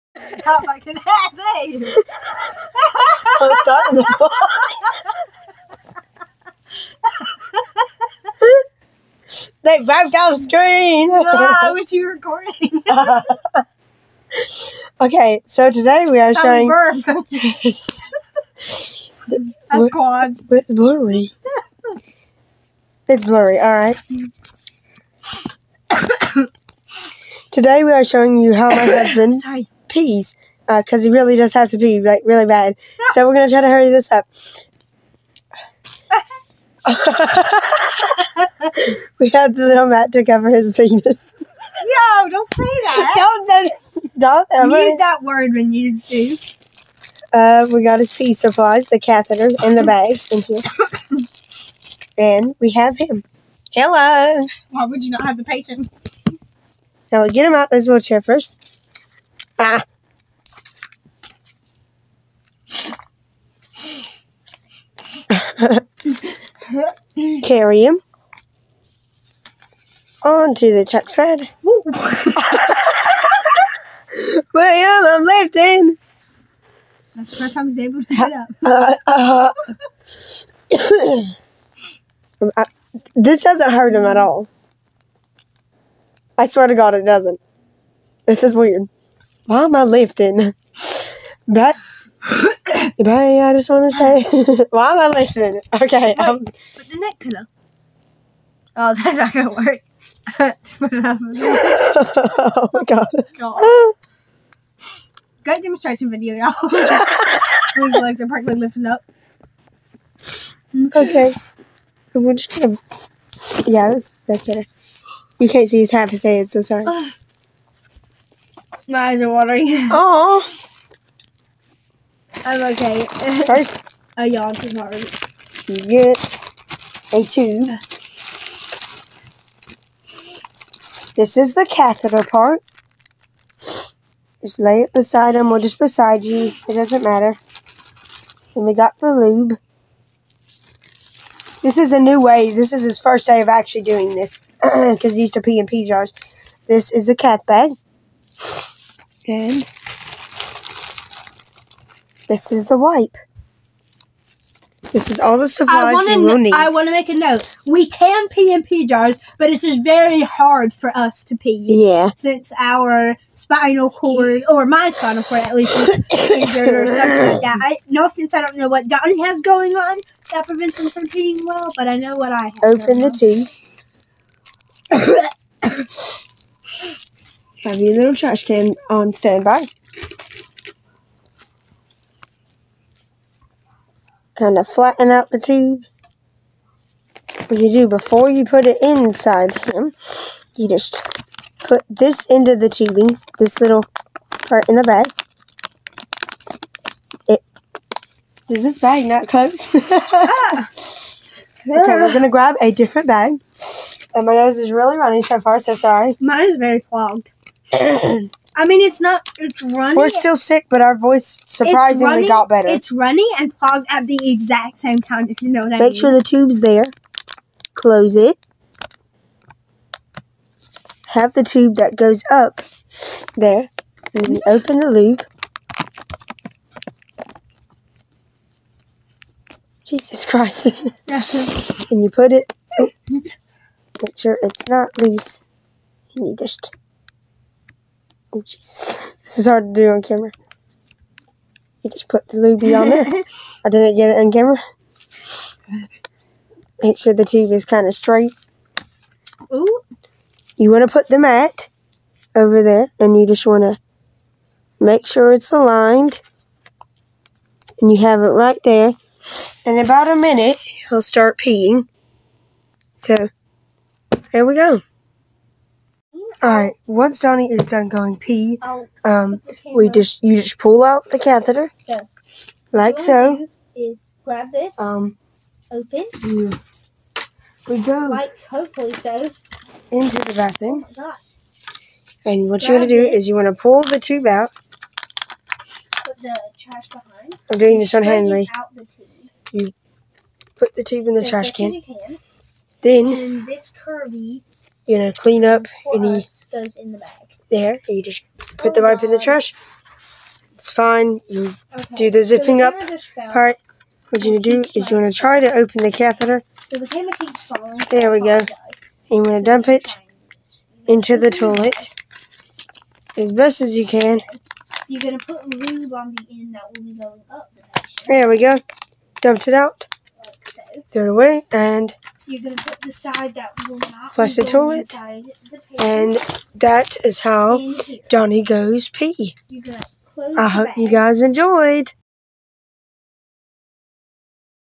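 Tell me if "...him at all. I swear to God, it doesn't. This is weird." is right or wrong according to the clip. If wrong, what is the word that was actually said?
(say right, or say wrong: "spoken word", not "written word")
right.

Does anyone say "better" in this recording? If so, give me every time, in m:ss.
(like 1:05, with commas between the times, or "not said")
1:54, 3:32.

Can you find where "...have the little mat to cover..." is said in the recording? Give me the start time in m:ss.
0:39.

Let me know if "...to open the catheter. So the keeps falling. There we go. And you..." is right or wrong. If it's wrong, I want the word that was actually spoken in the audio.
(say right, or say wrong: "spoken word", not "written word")
right.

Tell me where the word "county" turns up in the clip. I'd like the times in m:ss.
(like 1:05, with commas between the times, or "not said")
not said.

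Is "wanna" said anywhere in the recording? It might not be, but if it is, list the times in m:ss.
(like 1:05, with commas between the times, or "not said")
2:35, 4:43.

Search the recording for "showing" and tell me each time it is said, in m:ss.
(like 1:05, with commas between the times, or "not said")
0:16, 0:28.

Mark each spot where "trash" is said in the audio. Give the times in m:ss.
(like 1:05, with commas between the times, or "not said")
2:58, 4:46, 4:51, 4:59.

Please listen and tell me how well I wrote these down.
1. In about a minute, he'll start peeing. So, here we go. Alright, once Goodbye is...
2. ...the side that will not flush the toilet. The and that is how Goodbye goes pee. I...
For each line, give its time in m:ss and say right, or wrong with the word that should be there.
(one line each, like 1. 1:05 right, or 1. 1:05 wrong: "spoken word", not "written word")
1. 4:19 wrong: "Donny", not "Goodbye"
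2. 5:22 wrong: "Donny", not "Goodbye".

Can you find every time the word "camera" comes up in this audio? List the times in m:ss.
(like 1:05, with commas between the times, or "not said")
4:00, 4:04.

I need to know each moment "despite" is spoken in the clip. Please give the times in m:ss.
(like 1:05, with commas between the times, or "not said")
not said.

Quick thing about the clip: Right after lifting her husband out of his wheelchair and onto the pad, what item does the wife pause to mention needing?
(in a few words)
neck pillow.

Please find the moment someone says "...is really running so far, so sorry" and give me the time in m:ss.
3:24.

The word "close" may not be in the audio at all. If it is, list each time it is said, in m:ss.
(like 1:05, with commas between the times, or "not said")
3:19, 3:37.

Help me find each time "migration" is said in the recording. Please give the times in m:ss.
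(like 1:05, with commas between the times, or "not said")
not said.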